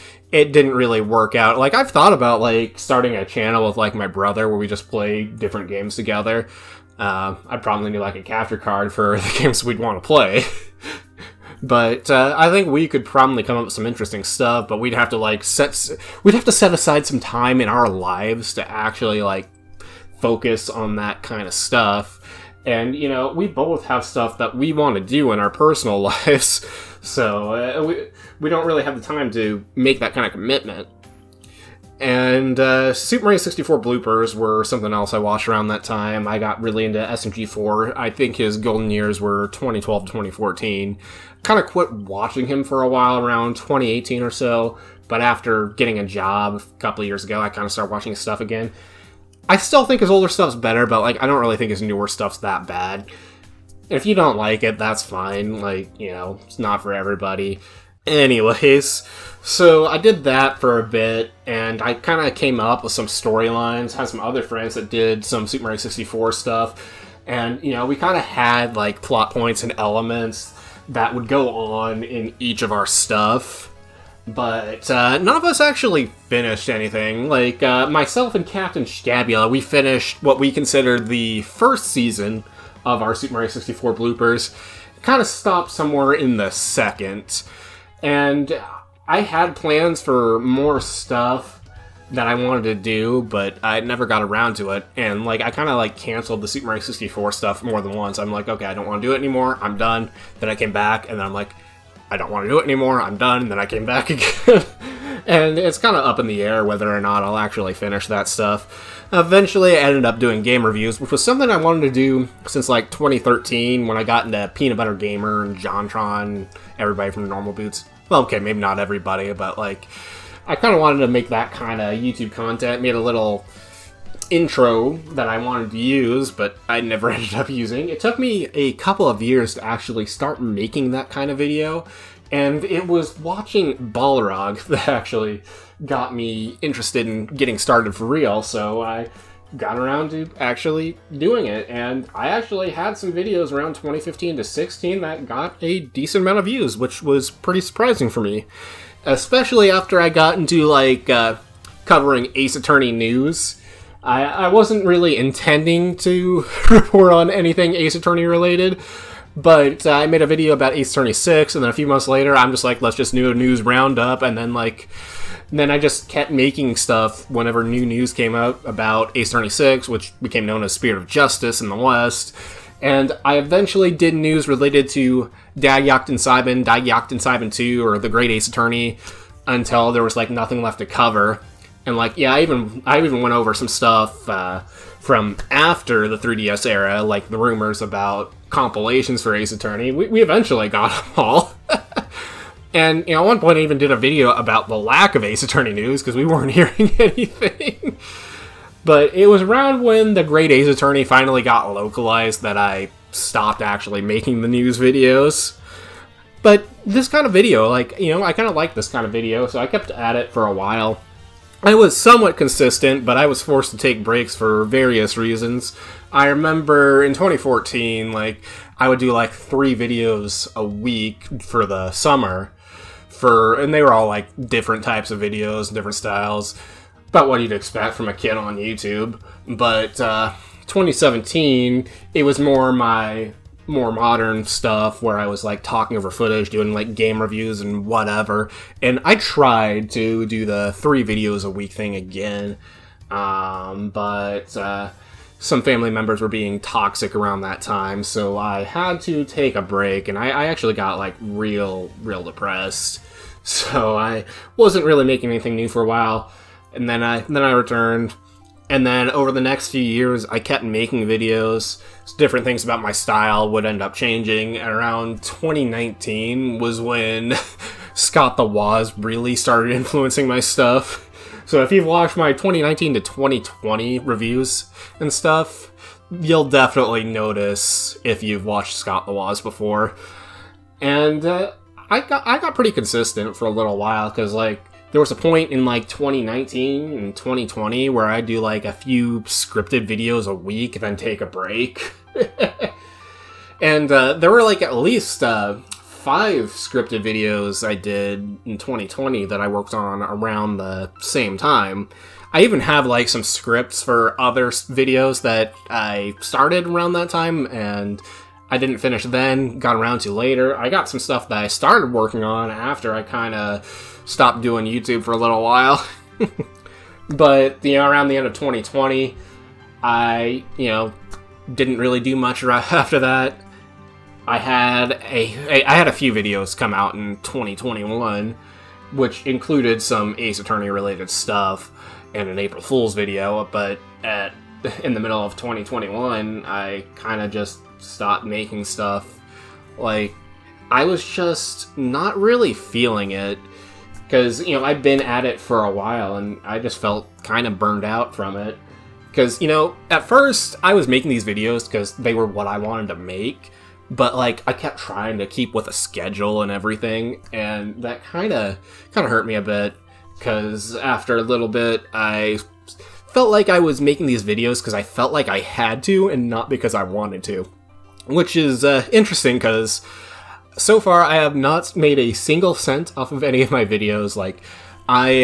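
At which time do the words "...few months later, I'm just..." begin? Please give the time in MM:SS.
02:41.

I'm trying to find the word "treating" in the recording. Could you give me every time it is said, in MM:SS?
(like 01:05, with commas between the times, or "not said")
not said.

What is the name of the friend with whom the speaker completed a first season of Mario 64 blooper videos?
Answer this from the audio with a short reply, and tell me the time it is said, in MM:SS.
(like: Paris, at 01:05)
Captain Stabula, at 01:18.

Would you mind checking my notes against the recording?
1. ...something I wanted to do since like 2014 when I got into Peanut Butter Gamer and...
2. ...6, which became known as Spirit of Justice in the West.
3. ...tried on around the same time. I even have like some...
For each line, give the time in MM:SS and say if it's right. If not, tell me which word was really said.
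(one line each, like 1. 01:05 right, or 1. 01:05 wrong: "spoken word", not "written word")
1. 01:51 wrong: "2013", not "2014"
2. 02:49 right
3. 04:59 wrong: "worked", not "tried".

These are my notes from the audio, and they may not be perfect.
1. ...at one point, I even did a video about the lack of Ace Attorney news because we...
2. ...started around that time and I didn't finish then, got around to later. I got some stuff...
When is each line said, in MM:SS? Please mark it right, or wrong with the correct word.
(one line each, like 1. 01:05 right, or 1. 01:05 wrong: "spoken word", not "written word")
1. 03:13 right
2. 05:06 right.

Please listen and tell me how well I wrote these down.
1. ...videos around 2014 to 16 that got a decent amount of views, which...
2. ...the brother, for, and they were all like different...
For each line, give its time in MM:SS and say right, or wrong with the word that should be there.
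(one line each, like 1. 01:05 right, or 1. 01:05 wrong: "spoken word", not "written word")
1. 02:23 wrong: "2015", not "2014"
2. 03:41 wrong: "summer", not "brother".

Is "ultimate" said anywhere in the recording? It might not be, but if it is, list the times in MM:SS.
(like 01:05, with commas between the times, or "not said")
not said.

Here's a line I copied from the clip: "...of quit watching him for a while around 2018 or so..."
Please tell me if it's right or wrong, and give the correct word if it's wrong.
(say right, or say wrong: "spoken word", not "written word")
right.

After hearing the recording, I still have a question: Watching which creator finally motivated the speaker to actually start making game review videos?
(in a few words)
Balrog.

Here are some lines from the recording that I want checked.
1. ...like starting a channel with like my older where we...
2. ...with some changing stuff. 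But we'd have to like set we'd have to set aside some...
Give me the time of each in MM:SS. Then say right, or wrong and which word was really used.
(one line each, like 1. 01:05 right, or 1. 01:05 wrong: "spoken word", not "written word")
1. 00:02 wrong: "brother", not "older"
2. 00:13 wrong: "interesting", not "changing".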